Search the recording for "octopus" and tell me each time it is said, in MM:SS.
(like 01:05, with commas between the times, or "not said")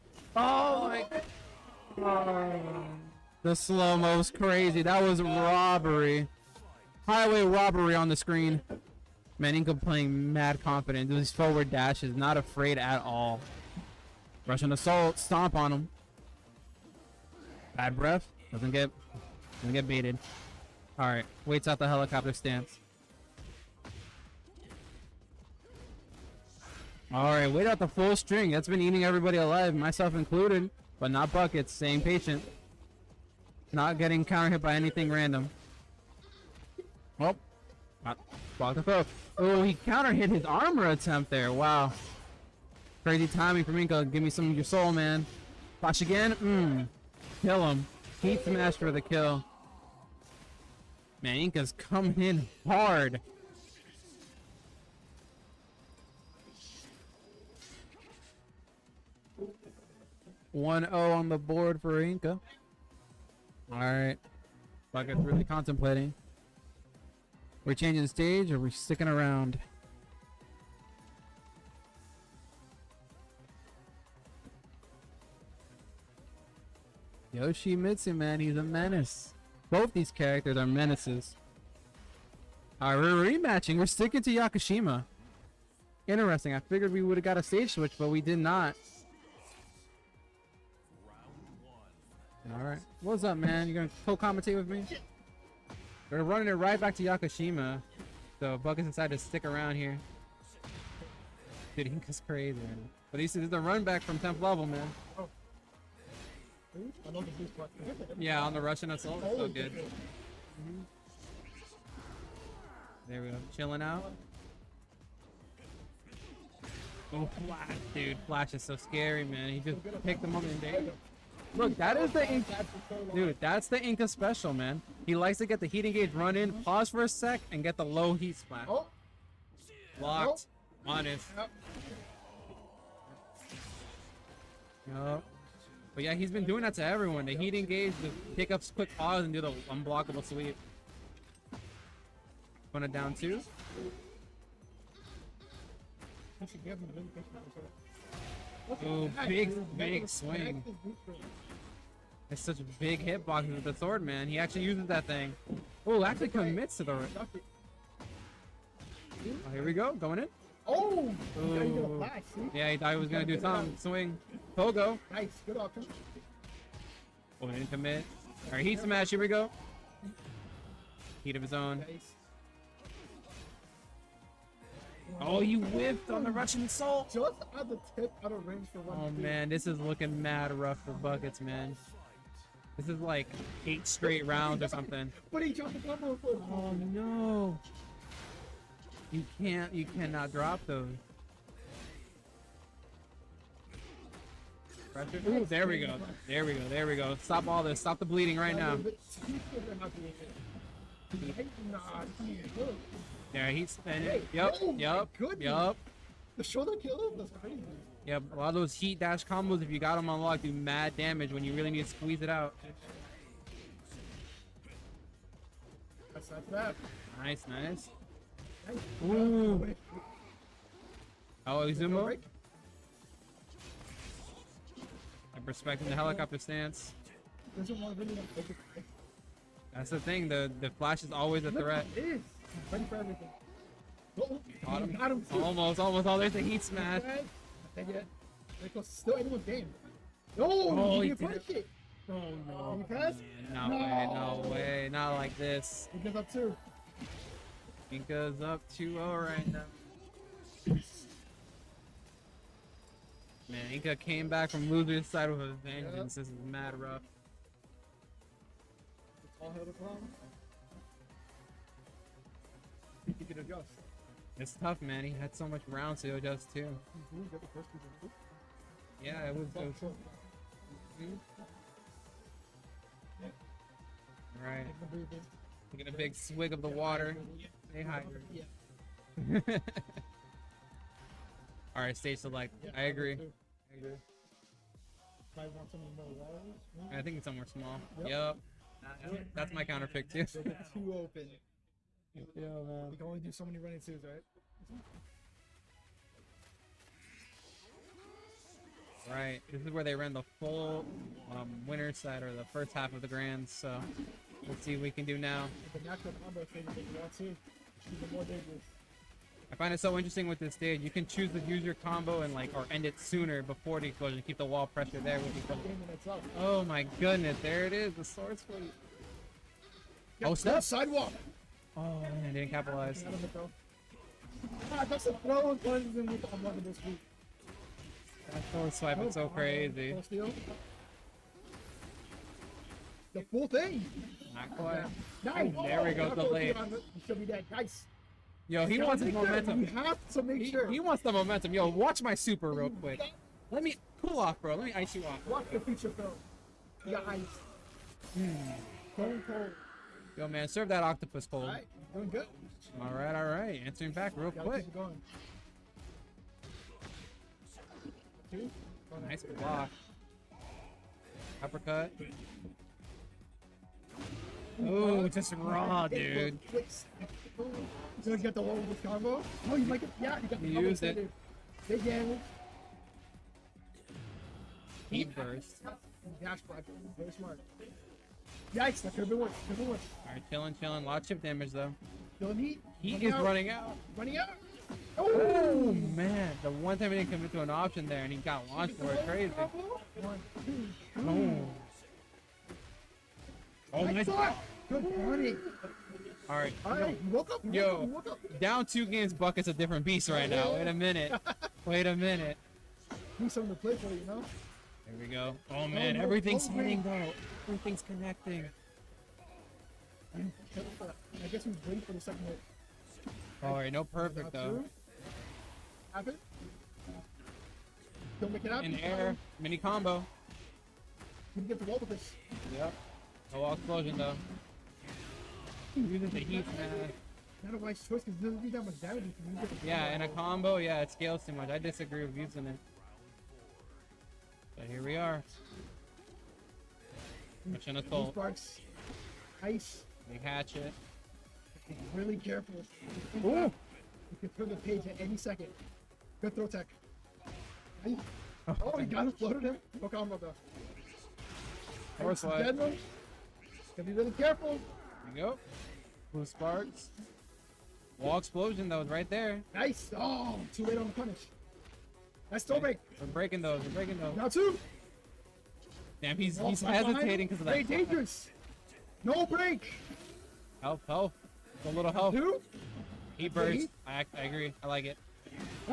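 05:50.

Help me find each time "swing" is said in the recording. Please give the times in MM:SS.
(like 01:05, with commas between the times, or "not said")
02:30, 02:43.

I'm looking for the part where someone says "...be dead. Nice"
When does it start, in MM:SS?
05:37.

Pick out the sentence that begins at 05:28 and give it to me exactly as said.
That sword swipe is oh, so crazy.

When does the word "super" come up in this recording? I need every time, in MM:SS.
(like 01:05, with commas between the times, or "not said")
05:42.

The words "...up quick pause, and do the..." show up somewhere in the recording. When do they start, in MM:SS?
02:18.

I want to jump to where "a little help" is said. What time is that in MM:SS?
07:51.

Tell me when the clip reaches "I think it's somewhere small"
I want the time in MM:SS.
04:46.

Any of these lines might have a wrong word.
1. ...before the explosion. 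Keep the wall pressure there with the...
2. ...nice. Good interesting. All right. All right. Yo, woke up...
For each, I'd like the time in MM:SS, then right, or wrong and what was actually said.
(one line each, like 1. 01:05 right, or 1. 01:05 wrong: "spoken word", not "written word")
1. 05:13 right
2. 06:33 wrong: "morning", not "interesting".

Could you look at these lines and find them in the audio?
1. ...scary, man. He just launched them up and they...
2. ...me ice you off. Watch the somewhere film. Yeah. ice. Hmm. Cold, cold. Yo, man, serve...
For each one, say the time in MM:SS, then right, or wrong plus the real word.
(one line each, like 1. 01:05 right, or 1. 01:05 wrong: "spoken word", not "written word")
1. 01:58 wrong: "picked", not "launched"
2. 05:44 wrong: "feature", not "somewhere".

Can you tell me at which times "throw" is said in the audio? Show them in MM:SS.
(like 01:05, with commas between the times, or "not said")
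05:25, 07:26.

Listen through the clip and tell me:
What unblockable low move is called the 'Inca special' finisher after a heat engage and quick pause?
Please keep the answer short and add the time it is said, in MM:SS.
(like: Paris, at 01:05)
low heat splat, at 02:07.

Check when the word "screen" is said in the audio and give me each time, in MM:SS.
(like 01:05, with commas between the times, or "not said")
00:08.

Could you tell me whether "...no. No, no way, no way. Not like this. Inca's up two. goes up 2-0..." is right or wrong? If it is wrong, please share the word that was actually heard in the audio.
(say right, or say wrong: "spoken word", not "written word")
right.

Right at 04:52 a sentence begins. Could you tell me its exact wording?
We can only do so many running twos, right?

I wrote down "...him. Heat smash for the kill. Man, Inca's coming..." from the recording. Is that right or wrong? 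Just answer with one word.
right.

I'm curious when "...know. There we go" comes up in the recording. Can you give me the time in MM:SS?
06:44.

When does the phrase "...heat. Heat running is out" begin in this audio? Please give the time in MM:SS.
06:22.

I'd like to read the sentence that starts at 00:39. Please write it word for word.
Oh, he counter hit his armor attempt there.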